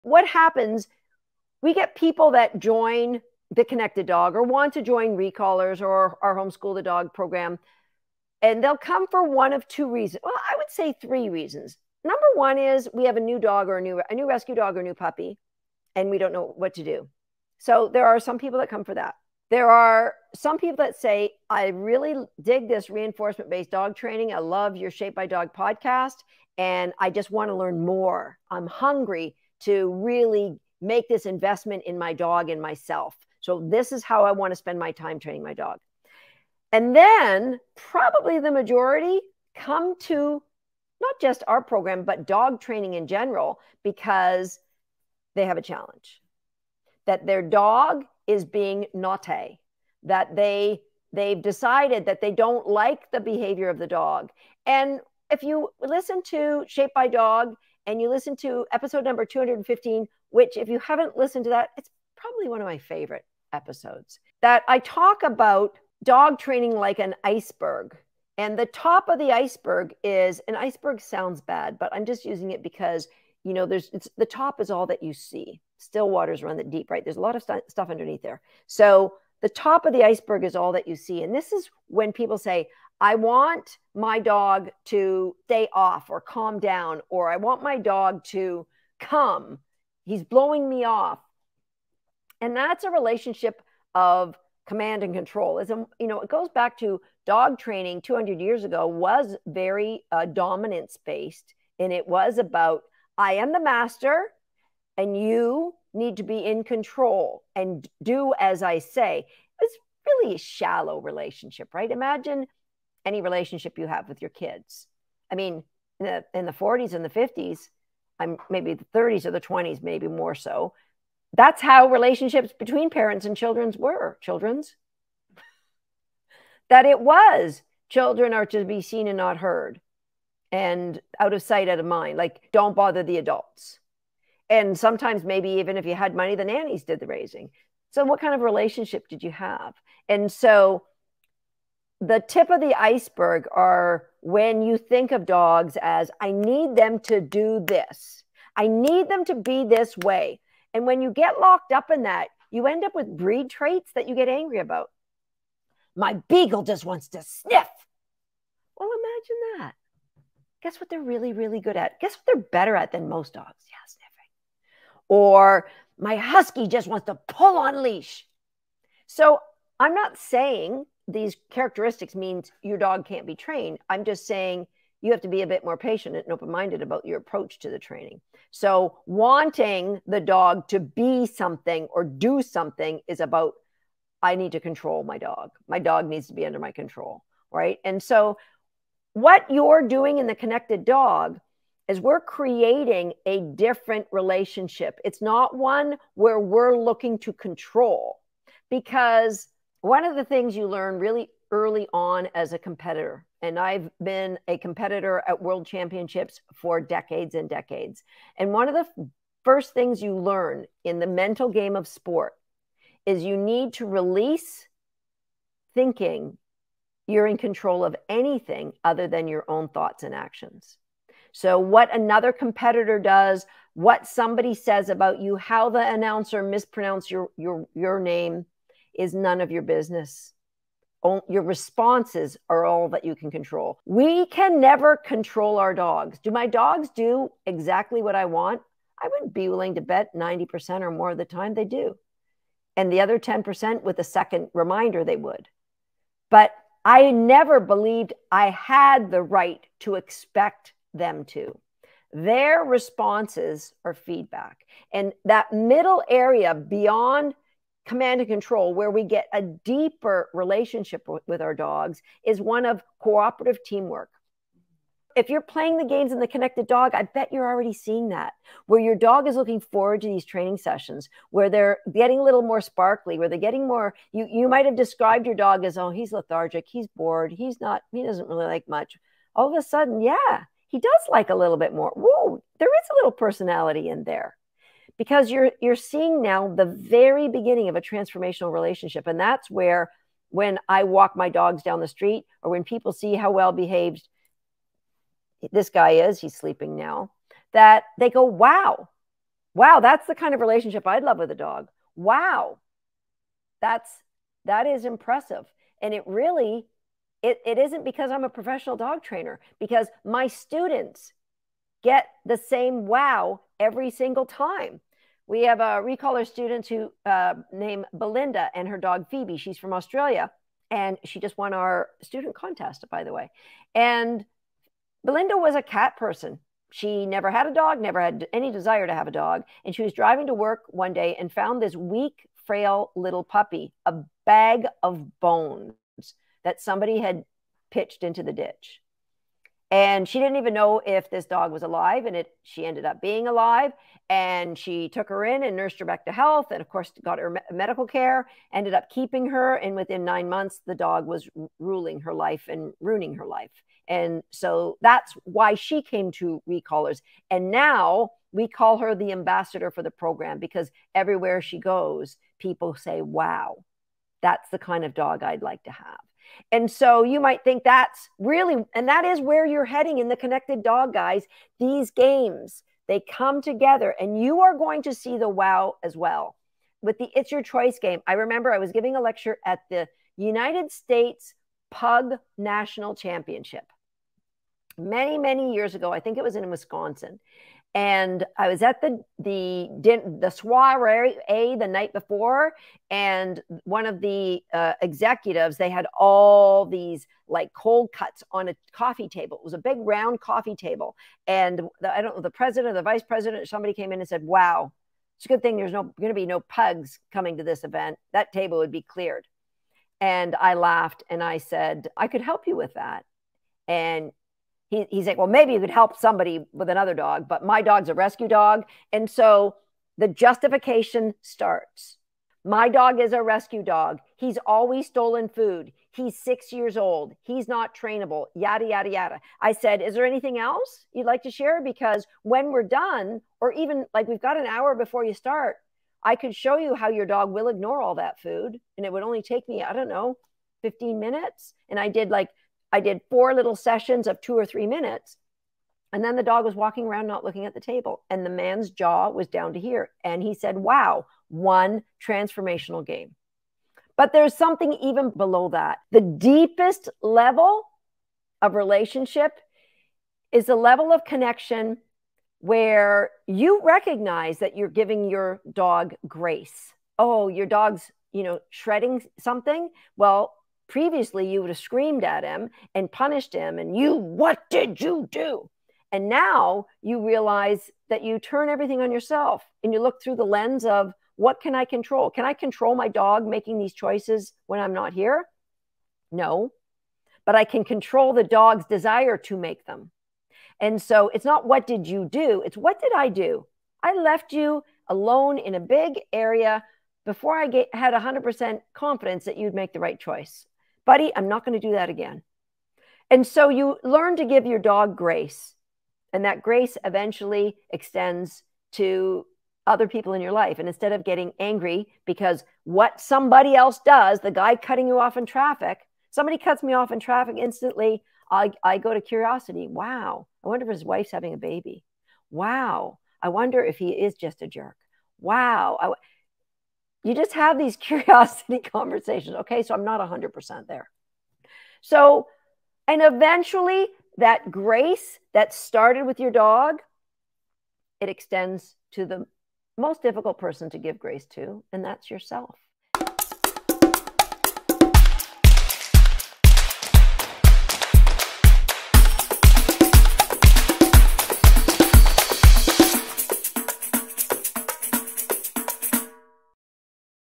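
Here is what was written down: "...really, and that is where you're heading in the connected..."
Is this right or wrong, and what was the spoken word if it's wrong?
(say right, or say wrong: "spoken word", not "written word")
right.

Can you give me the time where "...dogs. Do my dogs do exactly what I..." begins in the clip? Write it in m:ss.
3:55.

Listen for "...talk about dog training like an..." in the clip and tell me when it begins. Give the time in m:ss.
1:04.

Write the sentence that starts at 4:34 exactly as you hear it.
You you might have described your dog as, oh, he's lethargic, he's bored, he's not, he doesn't really like much.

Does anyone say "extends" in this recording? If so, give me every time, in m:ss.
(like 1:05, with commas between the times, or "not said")
8:27, 8:58.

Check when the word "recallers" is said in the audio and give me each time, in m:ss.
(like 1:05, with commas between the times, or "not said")
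0:05, 5:15, 5:56.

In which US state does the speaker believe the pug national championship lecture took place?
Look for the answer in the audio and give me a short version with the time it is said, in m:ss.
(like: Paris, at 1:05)
Wisconsin, at 6:26.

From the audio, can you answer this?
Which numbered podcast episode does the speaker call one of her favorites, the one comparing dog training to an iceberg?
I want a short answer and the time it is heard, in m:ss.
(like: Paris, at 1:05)
215, at 0:59.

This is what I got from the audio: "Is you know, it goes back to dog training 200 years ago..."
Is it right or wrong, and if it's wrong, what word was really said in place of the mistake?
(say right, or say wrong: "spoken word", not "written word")
right.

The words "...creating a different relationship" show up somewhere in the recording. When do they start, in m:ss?
3:12.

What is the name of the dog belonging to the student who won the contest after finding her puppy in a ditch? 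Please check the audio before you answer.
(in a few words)
Phoebe.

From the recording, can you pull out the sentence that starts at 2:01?
That's how relationships between parents and children's were.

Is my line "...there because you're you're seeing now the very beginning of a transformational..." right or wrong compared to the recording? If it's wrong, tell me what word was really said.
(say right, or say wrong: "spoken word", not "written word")
right.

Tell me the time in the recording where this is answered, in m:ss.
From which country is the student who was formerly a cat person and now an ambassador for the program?
5:19.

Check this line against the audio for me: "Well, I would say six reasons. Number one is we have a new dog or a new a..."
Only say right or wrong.
wrong.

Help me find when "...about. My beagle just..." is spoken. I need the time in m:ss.
2:34.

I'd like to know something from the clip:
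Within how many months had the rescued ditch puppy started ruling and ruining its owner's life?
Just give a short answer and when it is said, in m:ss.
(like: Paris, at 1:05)
9, at 5:50.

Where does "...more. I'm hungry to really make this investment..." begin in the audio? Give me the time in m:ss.
0:27.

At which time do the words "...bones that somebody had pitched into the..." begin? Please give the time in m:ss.
5:35.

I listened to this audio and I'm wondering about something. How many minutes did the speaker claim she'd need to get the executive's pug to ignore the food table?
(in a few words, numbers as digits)
15.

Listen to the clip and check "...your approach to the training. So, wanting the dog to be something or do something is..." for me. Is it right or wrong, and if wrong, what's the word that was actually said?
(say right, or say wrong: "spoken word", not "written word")
right.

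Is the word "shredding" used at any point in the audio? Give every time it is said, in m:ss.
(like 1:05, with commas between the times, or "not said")
7:48.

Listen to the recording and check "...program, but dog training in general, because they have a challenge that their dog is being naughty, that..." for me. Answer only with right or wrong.
right.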